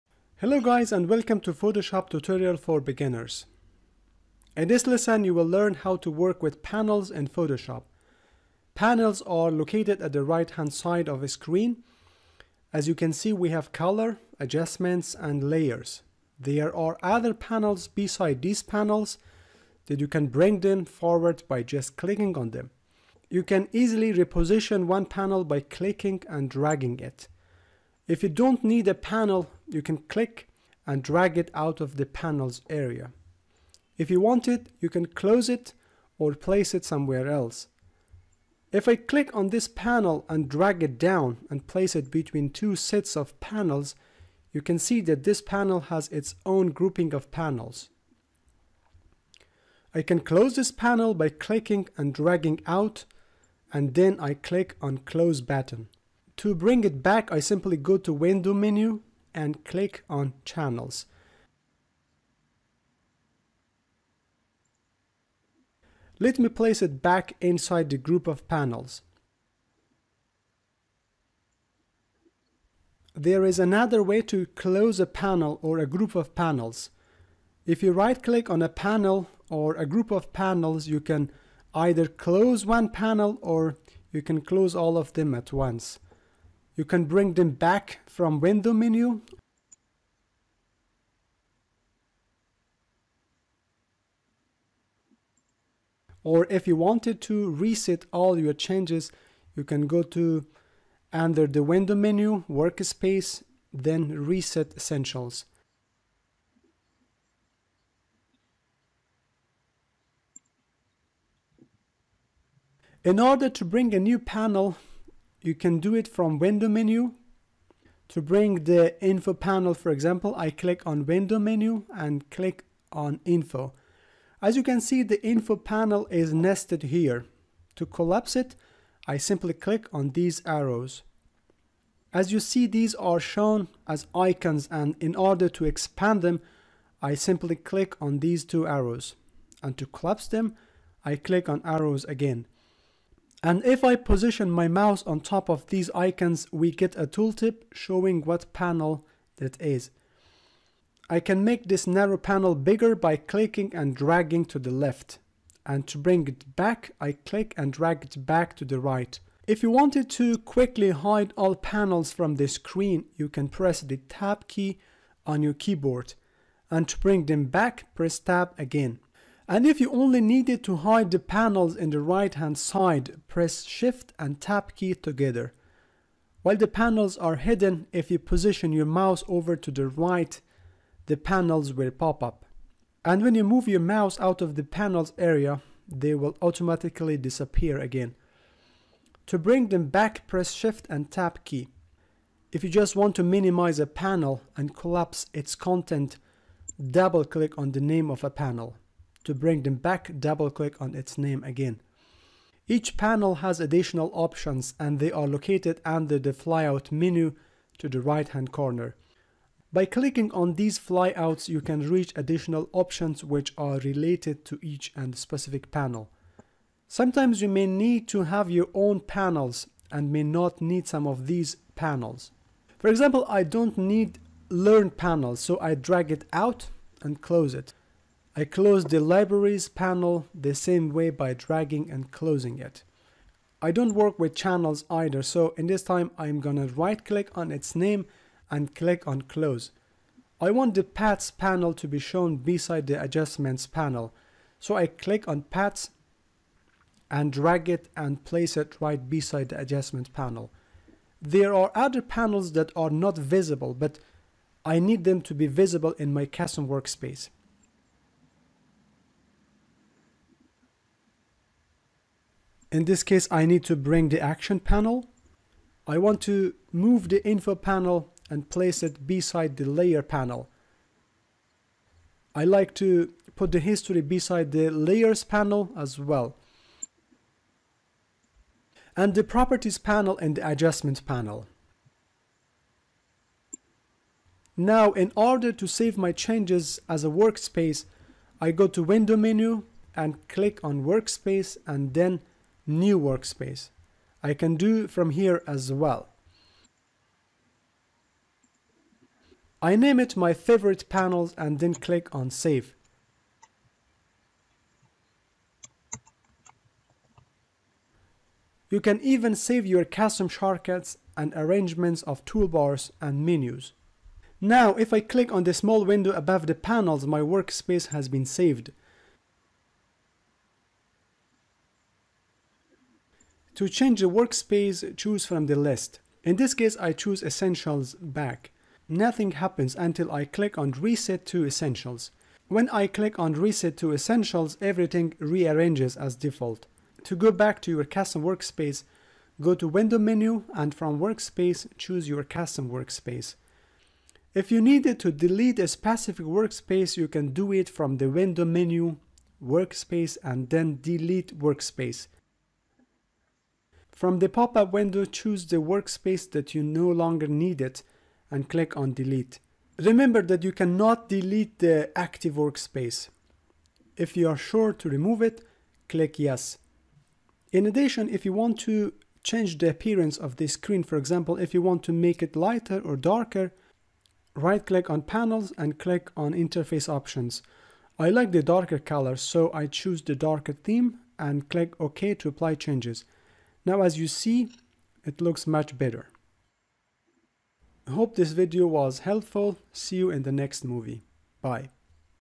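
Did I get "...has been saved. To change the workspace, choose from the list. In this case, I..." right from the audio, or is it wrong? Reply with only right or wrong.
right.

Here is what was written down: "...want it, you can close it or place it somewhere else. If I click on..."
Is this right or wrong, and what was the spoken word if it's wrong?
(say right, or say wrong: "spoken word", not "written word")
right.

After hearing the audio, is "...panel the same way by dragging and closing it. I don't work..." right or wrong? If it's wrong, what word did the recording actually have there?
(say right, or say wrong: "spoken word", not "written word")
right.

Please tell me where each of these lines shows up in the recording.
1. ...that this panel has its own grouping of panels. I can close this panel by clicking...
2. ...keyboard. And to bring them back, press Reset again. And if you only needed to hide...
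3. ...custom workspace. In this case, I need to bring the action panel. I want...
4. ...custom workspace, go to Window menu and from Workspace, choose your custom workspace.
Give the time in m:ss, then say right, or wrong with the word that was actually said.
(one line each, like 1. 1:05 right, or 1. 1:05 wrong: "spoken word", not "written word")
1. 0:45 right
2. 2:45 wrong: "Tab", not "Reset"
3. 4:16 right
4. 5:37 right.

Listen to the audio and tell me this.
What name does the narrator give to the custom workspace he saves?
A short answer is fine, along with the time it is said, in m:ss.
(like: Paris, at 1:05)
My favorite panels, at 5:00.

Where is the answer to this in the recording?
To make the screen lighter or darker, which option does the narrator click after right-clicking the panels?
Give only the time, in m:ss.
6:16.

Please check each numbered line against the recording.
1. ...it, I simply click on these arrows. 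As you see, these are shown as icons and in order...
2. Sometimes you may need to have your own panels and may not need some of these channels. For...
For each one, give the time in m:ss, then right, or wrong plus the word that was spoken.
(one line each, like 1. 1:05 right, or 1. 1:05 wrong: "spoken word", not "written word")
1. 2:08 right
2. 3:36 wrong: "panels", not "channels".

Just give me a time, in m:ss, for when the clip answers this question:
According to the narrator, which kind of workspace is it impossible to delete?
6:01.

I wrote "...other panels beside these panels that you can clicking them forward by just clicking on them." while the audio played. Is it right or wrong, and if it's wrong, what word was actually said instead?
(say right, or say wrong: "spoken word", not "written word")
wrong: "bring", not "clicking".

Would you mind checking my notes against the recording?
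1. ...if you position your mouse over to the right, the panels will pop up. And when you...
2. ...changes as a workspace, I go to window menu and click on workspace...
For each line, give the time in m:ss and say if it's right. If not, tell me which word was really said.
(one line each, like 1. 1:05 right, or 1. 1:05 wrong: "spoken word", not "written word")
1. 2:57 right
2. 4:46 right.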